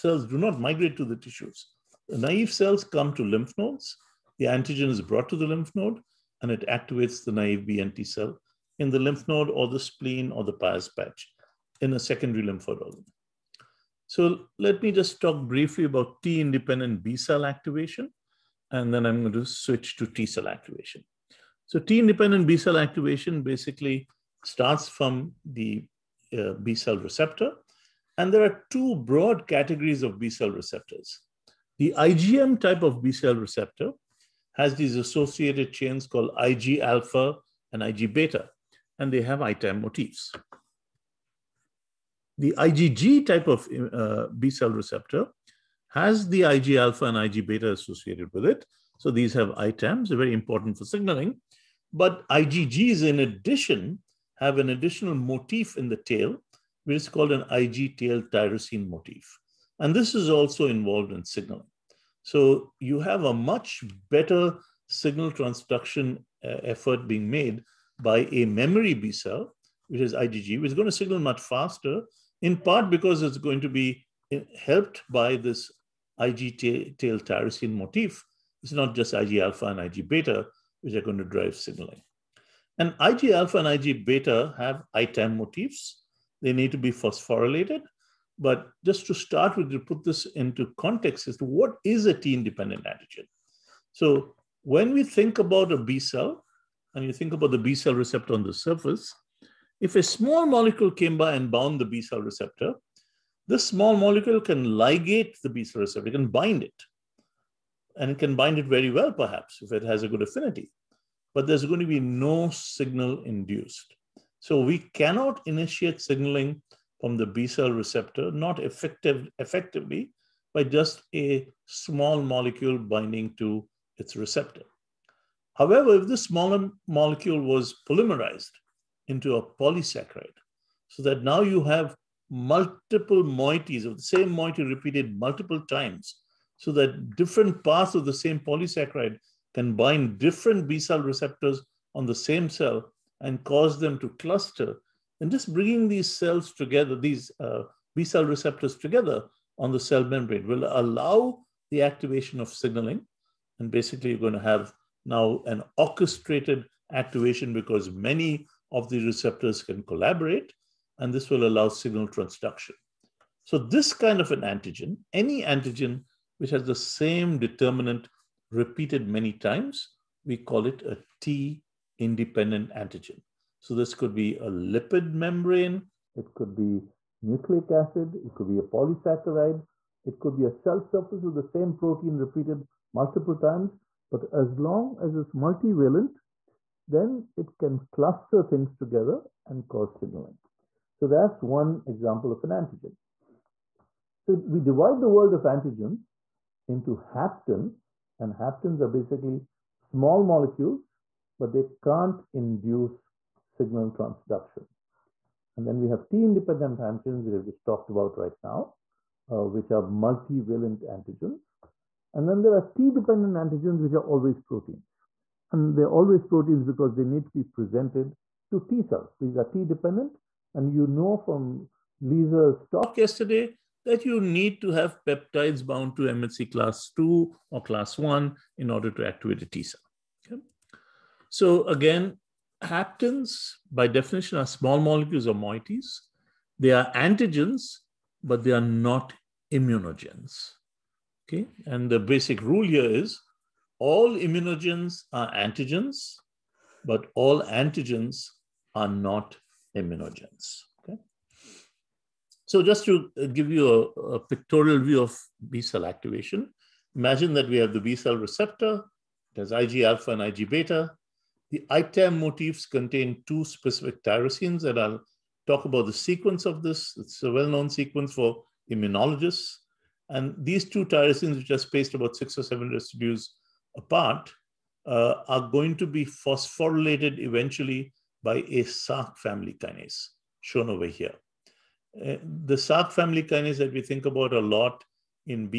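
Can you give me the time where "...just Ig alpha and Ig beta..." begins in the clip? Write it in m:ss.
1:18.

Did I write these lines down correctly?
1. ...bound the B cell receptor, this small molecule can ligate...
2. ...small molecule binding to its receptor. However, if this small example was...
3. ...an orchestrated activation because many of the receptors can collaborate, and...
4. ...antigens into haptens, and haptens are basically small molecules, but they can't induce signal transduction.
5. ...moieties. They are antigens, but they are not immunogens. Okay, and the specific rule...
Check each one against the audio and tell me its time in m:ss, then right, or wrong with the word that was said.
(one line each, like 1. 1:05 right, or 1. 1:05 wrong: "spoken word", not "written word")
1. 1:41 right
2. 2:01 wrong: "molecule", not "example"
3. 2:35 right
4. 3:15 right
5. 3:55 wrong: "basic", not "specific".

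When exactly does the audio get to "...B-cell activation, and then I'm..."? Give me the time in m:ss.
0:17.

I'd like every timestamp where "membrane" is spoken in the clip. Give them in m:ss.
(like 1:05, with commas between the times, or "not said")
2:30, 2:55.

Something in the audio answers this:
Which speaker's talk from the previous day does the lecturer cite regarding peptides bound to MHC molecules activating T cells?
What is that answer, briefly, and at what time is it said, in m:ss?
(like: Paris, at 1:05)
Lisa, at 3:41.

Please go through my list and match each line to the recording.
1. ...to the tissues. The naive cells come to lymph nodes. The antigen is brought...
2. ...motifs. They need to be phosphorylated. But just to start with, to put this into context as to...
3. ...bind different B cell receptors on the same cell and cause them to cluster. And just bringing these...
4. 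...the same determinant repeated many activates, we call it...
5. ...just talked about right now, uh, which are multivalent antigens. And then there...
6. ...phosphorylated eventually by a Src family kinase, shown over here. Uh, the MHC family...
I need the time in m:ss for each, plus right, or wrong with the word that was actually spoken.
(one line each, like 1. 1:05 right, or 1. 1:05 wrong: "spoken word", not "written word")
1. 0:00 right
2. 1:25 right
3. 2:19 right
4. 2:46 wrong: "times", not "activates"
5. 3:27 right
6. 4:36 wrong: "Src", not "MHC".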